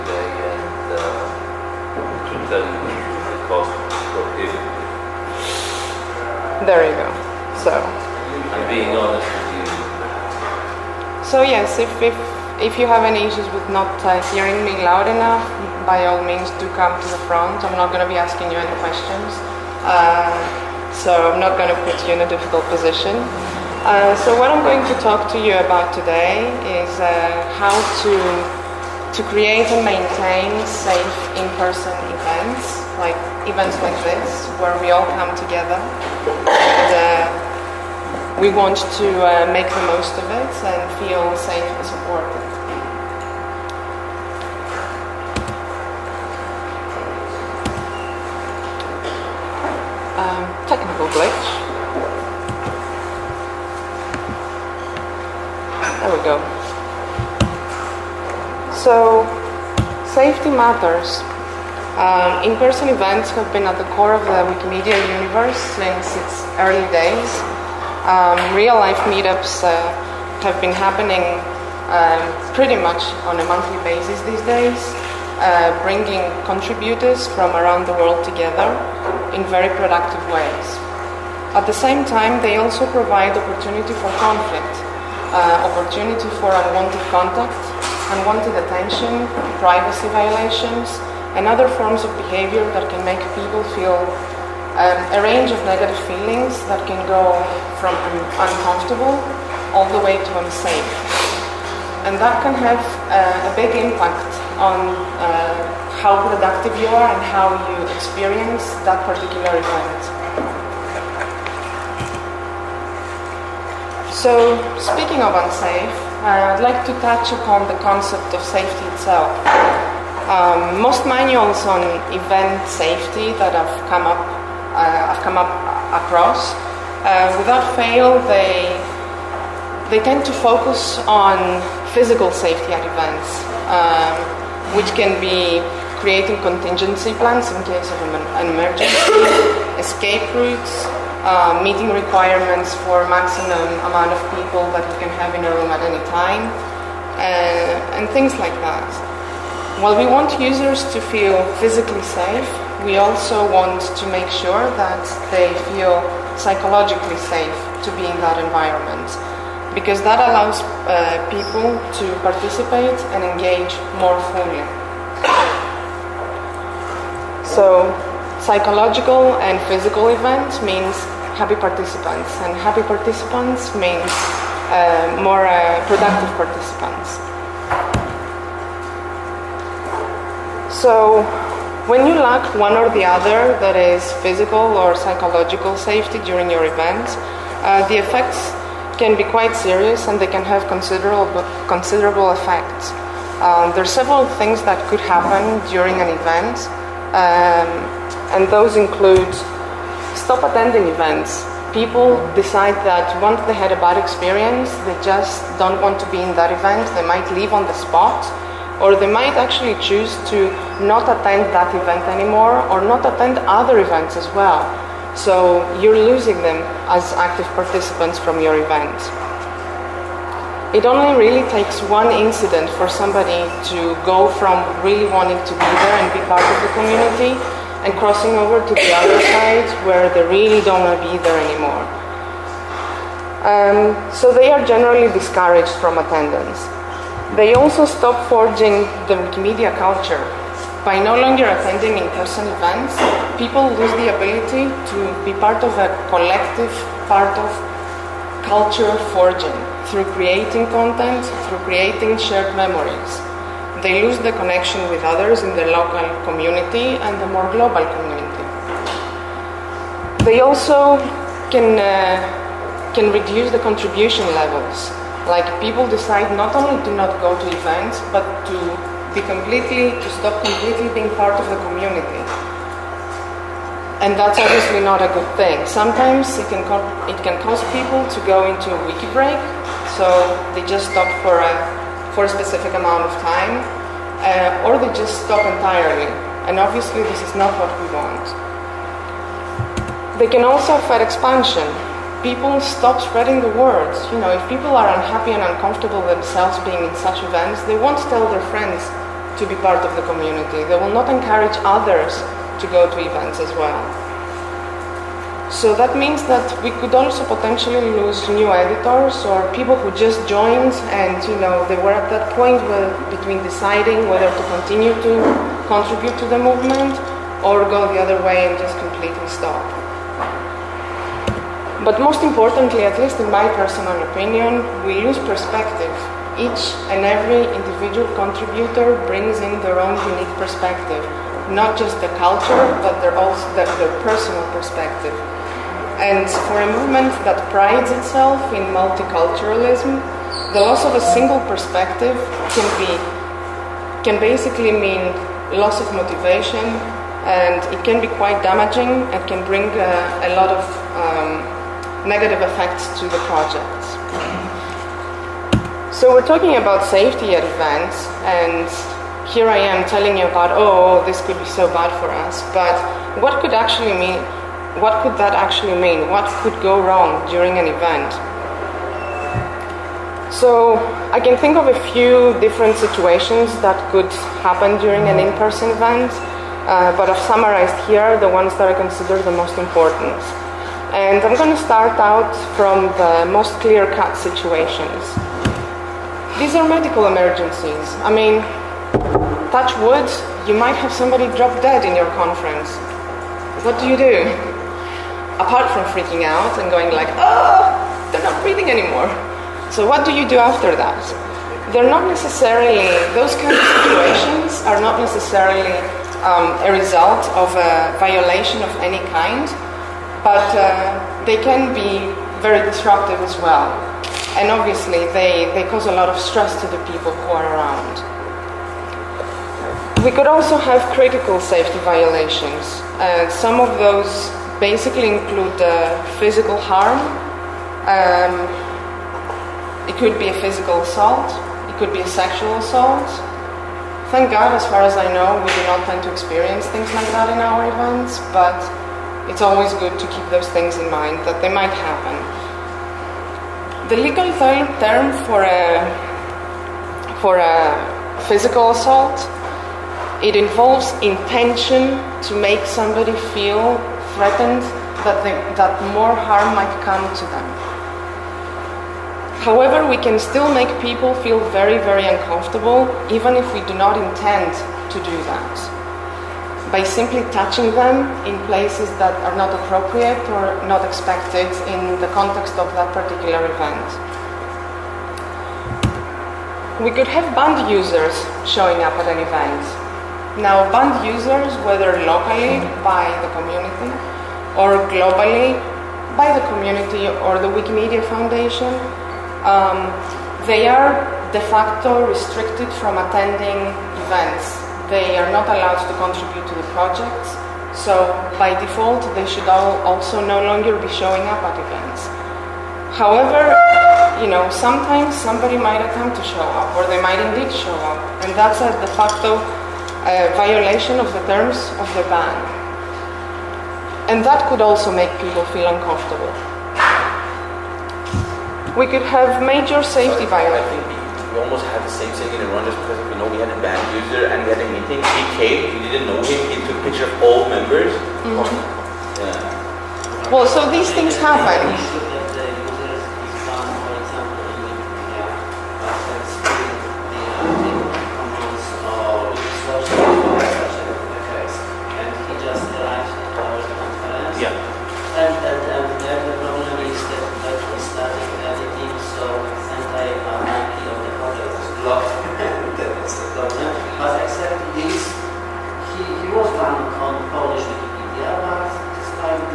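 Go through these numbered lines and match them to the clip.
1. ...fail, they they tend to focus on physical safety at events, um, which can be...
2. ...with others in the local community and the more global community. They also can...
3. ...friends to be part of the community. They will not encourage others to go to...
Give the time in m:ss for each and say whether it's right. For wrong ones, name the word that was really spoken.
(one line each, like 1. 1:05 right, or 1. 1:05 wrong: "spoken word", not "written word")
1. 2:07 right
2. 4:14 right
3. 4:58 right.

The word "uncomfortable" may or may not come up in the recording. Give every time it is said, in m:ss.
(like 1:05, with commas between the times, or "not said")
1:38, 4:55, 7:42, 8:35.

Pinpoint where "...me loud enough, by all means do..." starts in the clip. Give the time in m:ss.
0:14.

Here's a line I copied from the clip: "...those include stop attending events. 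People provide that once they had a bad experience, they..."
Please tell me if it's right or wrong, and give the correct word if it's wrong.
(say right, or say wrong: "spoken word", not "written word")
wrong: "decide", not "provide".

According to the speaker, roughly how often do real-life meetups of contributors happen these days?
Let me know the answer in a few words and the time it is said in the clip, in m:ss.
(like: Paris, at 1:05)
Monthly, at 1:13.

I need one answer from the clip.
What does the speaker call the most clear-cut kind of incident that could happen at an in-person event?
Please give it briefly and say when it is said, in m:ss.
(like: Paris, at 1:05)
Medical emergencies, at 6:26.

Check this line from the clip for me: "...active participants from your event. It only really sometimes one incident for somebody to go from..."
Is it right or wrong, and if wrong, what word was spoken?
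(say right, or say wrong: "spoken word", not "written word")
wrong: "takes", not "sometimes".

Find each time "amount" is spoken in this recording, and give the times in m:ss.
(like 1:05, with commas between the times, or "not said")
2:23, 4:42.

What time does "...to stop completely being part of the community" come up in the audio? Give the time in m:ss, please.
4:29.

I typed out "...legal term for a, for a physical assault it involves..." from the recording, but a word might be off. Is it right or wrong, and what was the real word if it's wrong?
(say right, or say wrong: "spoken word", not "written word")
right.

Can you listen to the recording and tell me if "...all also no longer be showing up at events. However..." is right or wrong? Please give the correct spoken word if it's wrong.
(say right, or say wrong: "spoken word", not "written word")
right.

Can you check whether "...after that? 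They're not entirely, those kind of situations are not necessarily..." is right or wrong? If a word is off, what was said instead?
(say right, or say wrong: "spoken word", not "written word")
wrong: "necessarily", not "entirely".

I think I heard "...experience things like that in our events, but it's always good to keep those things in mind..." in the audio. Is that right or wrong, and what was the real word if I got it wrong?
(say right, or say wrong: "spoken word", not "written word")
right.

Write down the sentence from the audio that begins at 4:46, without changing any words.
And obviously, this is not what we want.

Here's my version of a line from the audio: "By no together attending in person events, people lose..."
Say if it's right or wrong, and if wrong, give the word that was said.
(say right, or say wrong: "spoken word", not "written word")
wrong: "longer", not "together".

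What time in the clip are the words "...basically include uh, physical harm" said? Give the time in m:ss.
7:04.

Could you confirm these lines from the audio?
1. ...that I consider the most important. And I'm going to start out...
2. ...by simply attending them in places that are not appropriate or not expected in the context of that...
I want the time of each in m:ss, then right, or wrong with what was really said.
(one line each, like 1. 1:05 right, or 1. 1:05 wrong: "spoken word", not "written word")
1. 6:18 right
2. 7:46 wrong: "touching", not "attending".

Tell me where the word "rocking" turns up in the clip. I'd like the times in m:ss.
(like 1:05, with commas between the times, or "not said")
not said.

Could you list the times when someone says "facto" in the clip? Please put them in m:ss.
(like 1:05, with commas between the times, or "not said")
8:11, 8:28.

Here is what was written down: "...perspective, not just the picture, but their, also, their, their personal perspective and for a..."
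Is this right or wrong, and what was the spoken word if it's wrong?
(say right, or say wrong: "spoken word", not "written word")
wrong: "culture", not "picture".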